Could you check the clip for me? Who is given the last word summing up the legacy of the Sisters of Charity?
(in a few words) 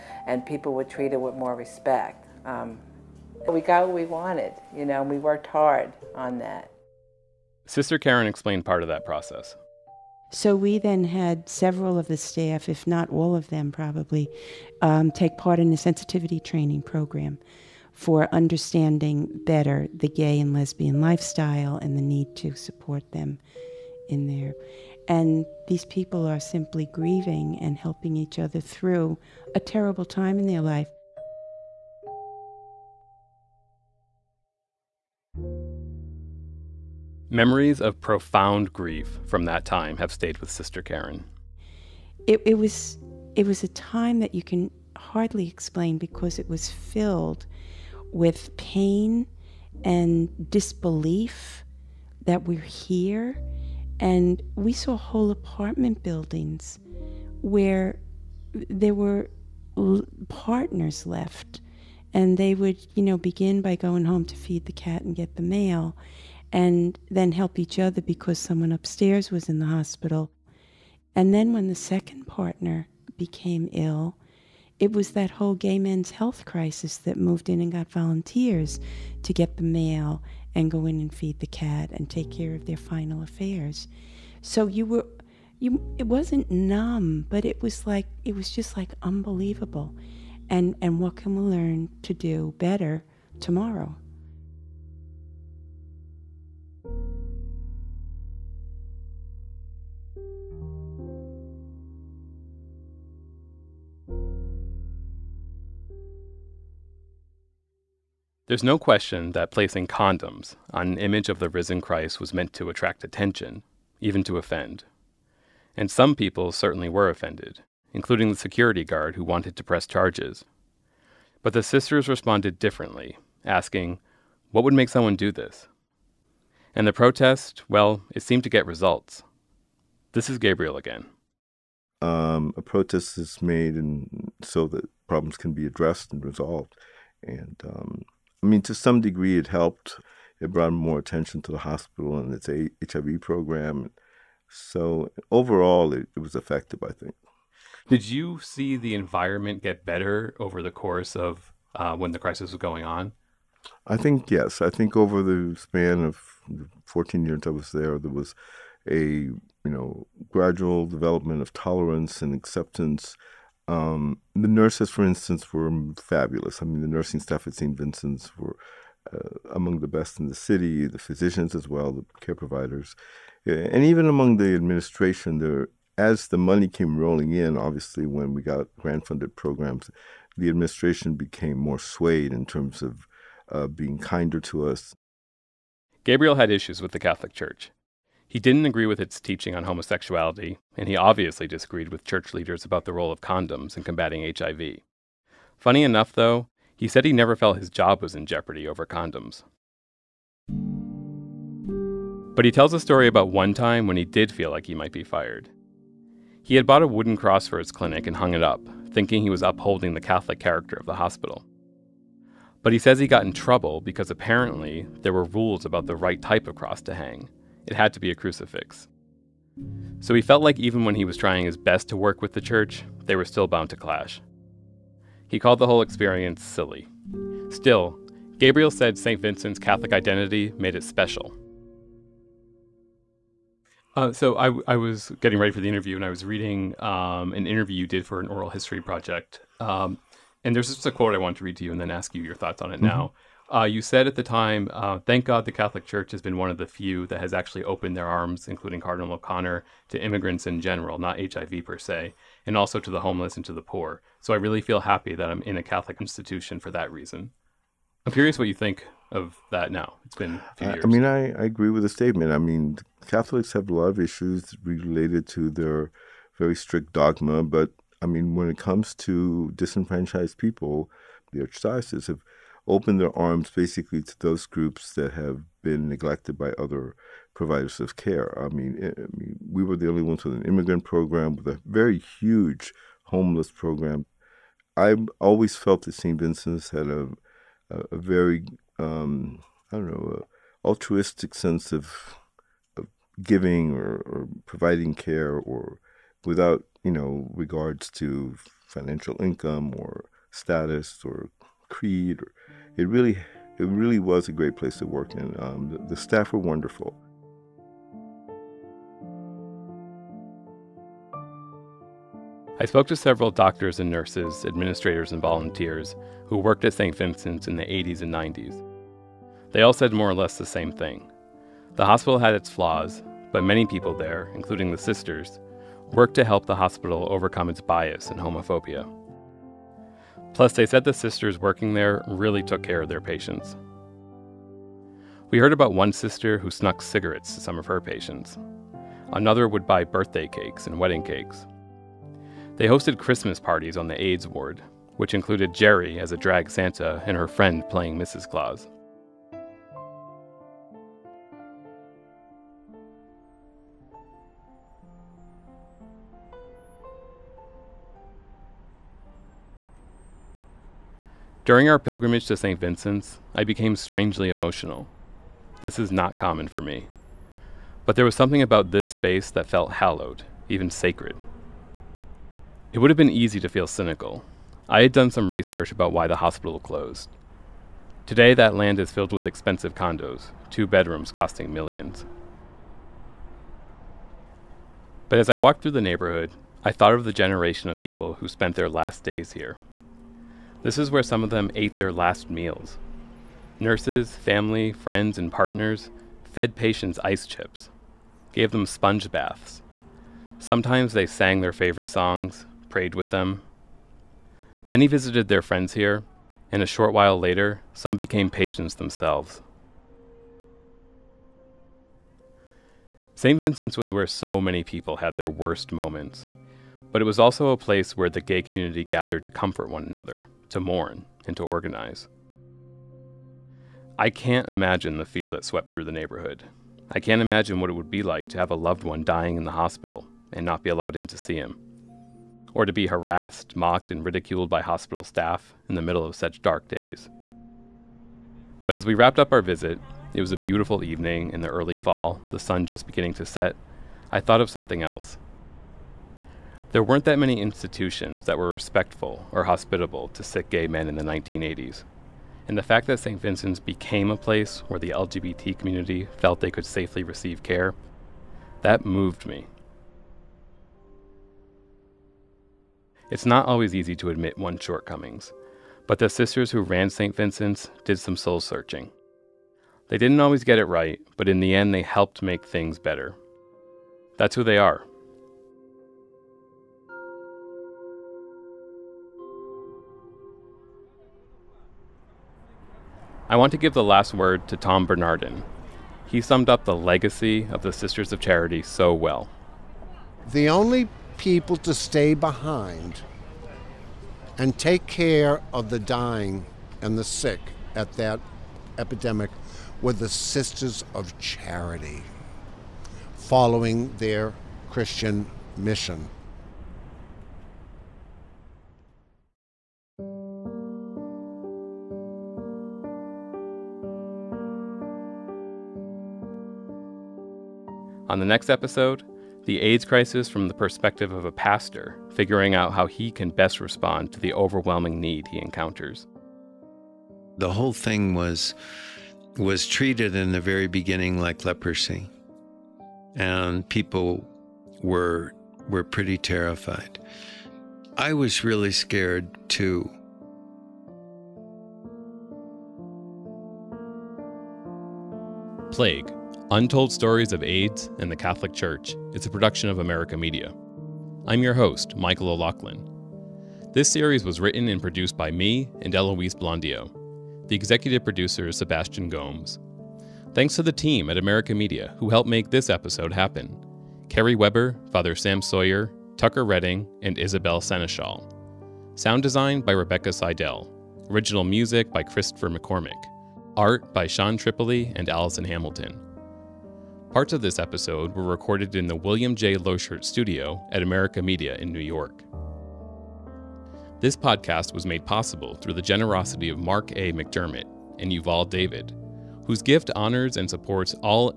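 Tom Bernardin.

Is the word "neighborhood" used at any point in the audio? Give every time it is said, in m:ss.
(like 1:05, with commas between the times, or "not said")
6:25, 7:05.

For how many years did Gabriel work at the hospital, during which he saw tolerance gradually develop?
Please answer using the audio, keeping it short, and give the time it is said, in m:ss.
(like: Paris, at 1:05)
14, at 2:36.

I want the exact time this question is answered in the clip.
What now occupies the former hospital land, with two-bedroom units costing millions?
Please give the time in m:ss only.
6:19.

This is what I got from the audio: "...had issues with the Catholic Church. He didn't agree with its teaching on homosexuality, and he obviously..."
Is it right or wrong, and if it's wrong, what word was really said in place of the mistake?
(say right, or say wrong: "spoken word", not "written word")
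right.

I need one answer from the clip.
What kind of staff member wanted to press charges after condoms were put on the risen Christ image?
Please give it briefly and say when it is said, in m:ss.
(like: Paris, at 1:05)
Security guard, at 1:58.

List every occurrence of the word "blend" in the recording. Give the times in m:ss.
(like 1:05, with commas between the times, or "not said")
not said.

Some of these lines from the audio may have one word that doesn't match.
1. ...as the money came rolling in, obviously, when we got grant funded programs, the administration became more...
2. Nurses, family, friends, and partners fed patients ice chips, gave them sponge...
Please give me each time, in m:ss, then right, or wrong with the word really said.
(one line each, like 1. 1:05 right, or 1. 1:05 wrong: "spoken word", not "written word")
1. 2:55 right
2. 6:33 right.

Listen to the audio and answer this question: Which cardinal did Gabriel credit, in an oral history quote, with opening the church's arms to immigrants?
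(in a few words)
Cardinal O'Connor.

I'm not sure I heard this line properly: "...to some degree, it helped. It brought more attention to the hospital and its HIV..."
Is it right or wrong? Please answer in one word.
right.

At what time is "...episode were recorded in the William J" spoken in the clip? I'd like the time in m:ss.
9:37.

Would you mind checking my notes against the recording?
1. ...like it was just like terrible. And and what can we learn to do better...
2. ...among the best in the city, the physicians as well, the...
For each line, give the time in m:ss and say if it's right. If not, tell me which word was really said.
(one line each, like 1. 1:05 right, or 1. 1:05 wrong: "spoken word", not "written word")
1. 1:27 wrong: "unbelievable", not "terrible"
2. 2:49 right.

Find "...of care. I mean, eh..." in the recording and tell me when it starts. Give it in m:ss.
4:37.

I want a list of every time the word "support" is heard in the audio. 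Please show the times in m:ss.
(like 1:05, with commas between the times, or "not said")
0:22, 9:50.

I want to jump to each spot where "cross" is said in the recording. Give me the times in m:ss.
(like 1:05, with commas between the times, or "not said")
3:27, 3:36.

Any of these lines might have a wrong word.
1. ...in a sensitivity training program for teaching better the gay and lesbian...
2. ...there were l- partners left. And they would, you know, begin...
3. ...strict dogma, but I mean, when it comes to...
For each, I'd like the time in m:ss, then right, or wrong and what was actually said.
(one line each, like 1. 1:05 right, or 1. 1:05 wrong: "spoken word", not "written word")
1. 0:15 wrong: "understanding", not "teaching"
2. 0:58 right
3. 4:26 right.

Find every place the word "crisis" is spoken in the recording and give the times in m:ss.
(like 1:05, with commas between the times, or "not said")
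1:16, 2:32, 8:39.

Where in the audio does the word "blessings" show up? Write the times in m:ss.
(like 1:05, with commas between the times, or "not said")
not said.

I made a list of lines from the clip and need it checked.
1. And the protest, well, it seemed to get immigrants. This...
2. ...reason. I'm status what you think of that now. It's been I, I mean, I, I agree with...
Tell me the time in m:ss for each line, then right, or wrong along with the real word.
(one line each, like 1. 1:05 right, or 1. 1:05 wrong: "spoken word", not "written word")
1. 2:06 wrong: "results", not "immigrants"
2. 4:16 wrong: "curious", not "status".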